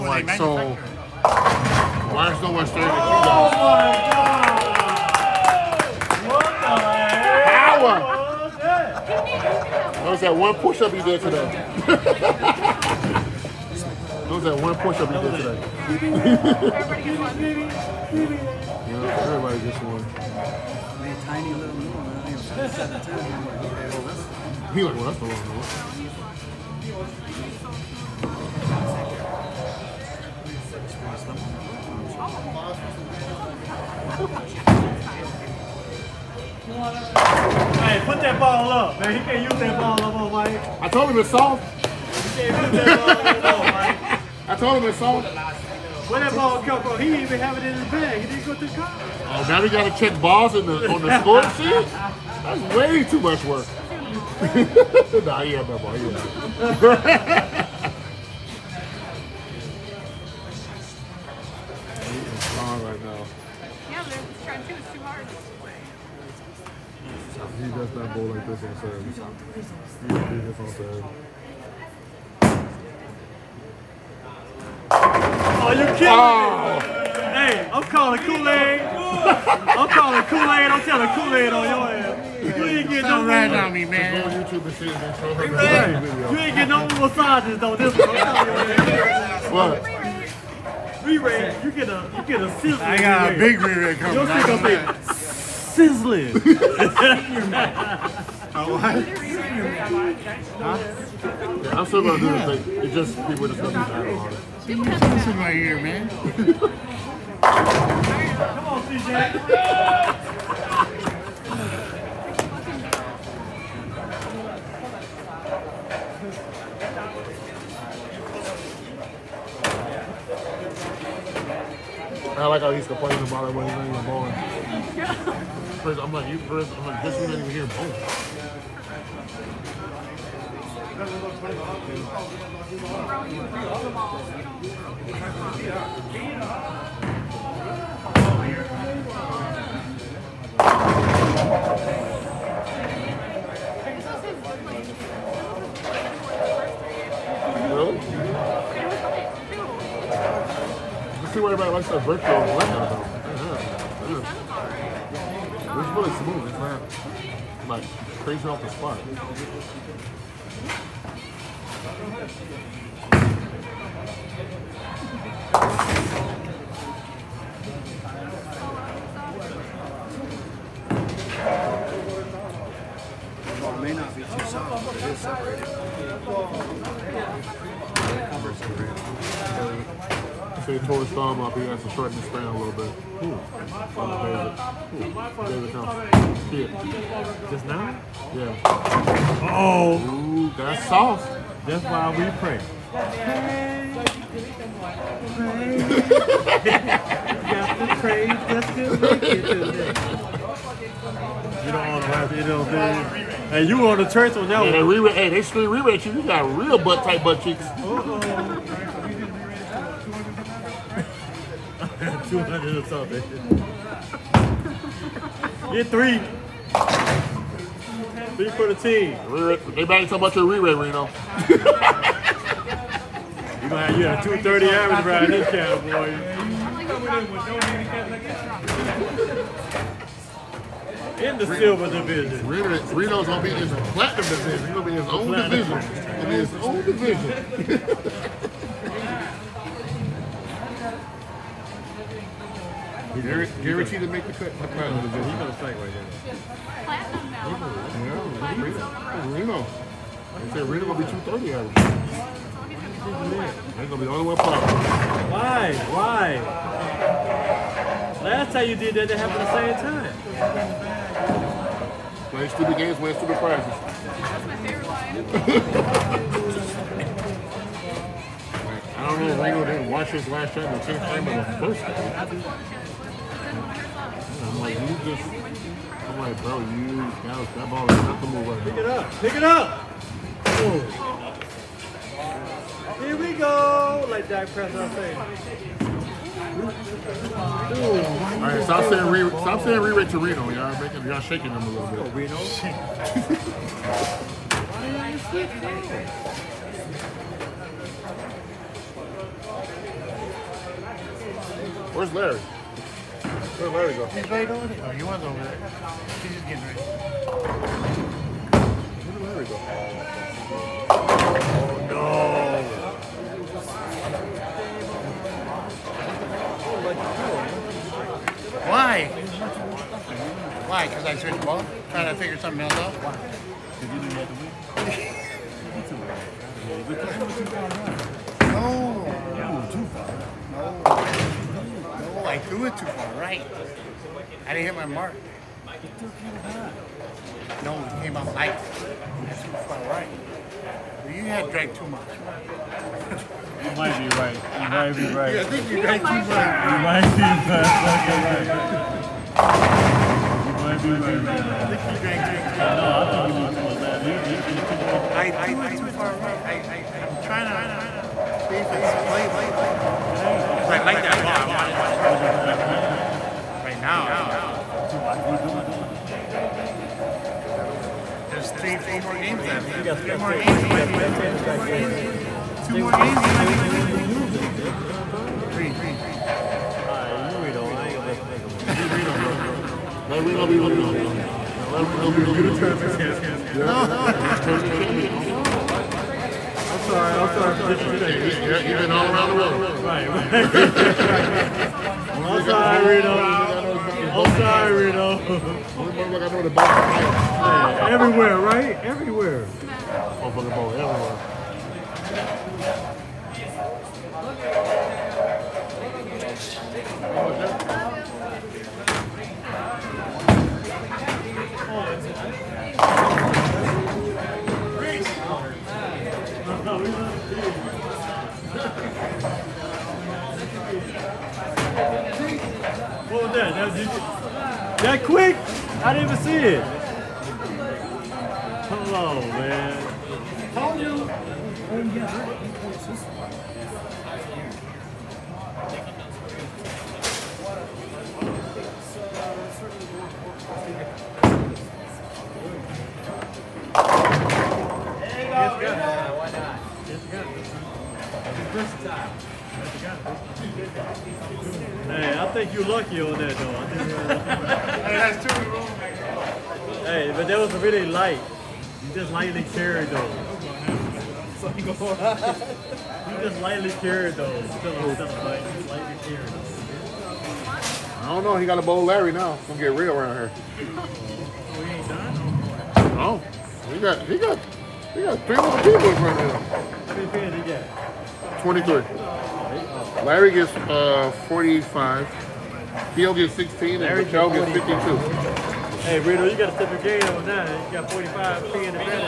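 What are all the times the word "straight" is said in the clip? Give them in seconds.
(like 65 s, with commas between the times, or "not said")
not said.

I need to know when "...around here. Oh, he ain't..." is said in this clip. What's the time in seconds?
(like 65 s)
469 s.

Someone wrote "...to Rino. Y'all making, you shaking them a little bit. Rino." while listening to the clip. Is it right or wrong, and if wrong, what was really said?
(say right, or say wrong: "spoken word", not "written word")
right.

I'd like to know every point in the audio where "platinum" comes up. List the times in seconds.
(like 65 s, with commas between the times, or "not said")
233 s, 246 s.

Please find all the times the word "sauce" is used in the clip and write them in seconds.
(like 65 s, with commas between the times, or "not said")
190 s.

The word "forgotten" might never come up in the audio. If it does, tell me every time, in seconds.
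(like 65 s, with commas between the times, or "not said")
not said.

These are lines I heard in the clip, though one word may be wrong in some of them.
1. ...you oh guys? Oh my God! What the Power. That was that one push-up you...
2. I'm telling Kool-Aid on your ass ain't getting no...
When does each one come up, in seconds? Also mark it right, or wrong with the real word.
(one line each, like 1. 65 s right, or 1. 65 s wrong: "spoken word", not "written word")
1. 2 s right
2. 80 s right.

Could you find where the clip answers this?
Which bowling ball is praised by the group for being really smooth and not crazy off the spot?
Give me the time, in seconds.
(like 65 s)
152 s.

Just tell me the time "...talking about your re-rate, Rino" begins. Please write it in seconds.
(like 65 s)
220 s.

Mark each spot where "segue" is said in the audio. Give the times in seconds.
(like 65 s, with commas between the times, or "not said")
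245 s.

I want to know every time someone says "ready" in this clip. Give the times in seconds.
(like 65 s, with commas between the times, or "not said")
306 s.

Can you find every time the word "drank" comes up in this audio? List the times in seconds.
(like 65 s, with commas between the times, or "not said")
341 s, 345 s, 352 s.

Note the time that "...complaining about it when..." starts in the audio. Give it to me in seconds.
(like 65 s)
122 s.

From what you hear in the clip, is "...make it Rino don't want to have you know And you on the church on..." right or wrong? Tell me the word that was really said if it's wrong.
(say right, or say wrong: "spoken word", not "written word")
wrong: "You", not "Rino".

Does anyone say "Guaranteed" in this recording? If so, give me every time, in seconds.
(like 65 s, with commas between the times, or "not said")
243 s.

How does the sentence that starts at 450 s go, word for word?
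Hey, I think you're lucky on that though.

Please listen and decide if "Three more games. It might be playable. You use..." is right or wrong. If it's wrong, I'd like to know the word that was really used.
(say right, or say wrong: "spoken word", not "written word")
wrong: "Two", not "Three".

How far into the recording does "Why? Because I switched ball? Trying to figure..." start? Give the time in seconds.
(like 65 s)
320 s.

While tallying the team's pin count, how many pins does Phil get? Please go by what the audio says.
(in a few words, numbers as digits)
16.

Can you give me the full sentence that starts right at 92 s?
I got a big re-rag coming.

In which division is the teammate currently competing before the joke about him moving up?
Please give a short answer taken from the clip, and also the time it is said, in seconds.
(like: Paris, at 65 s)
Silver division, at 231 s.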